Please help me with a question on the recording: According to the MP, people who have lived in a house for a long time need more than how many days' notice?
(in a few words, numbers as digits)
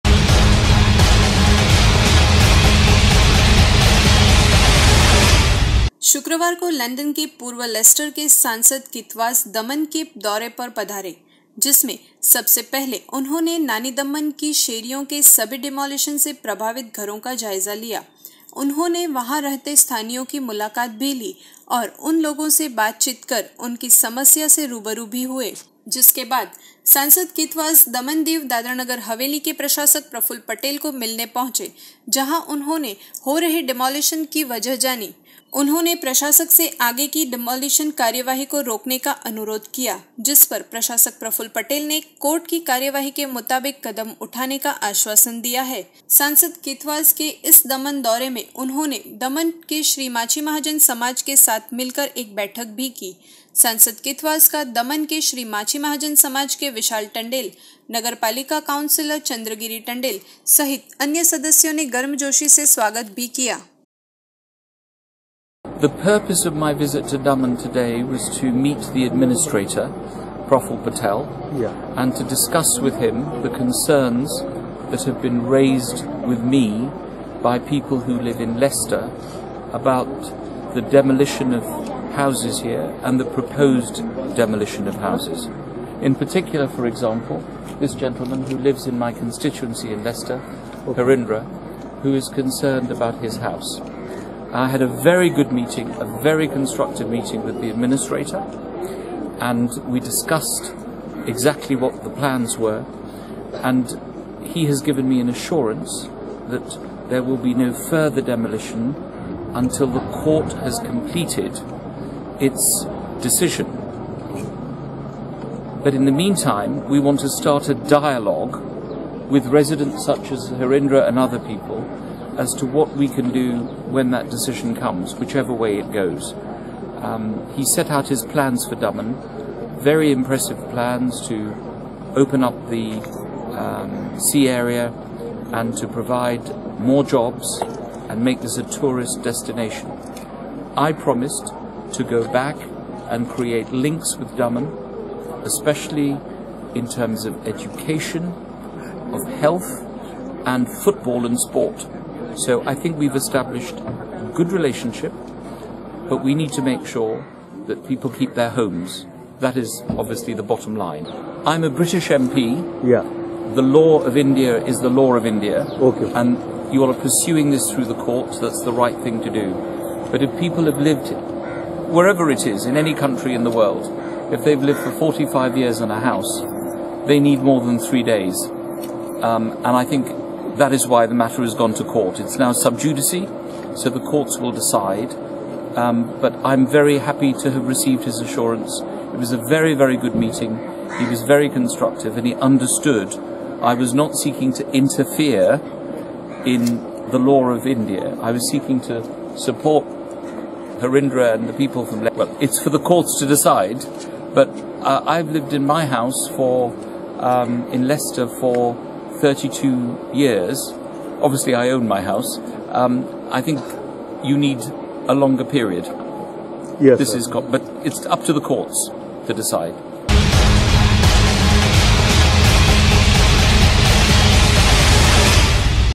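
3 days.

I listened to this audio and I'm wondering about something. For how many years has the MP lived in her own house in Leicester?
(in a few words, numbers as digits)
32.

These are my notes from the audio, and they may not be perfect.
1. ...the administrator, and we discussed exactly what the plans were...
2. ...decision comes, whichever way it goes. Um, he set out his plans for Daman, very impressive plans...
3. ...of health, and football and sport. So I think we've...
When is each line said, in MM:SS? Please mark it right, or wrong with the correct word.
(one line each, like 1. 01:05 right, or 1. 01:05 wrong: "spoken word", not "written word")
1. 01:37 right
2. 02:04 right
3. 02:29 right.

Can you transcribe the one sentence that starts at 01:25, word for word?
In particular, for example, this gentleman who lives in my constituency in Leicester, Harindra, who is concerned about his house.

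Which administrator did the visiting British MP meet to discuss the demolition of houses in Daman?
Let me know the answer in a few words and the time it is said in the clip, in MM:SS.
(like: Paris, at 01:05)
Praful Patel, at 01:10.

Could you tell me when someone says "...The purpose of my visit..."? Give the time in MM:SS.
01:05.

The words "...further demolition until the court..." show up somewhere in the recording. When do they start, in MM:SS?
01:47.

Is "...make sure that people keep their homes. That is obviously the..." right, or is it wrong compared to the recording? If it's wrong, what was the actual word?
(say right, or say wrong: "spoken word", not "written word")
right.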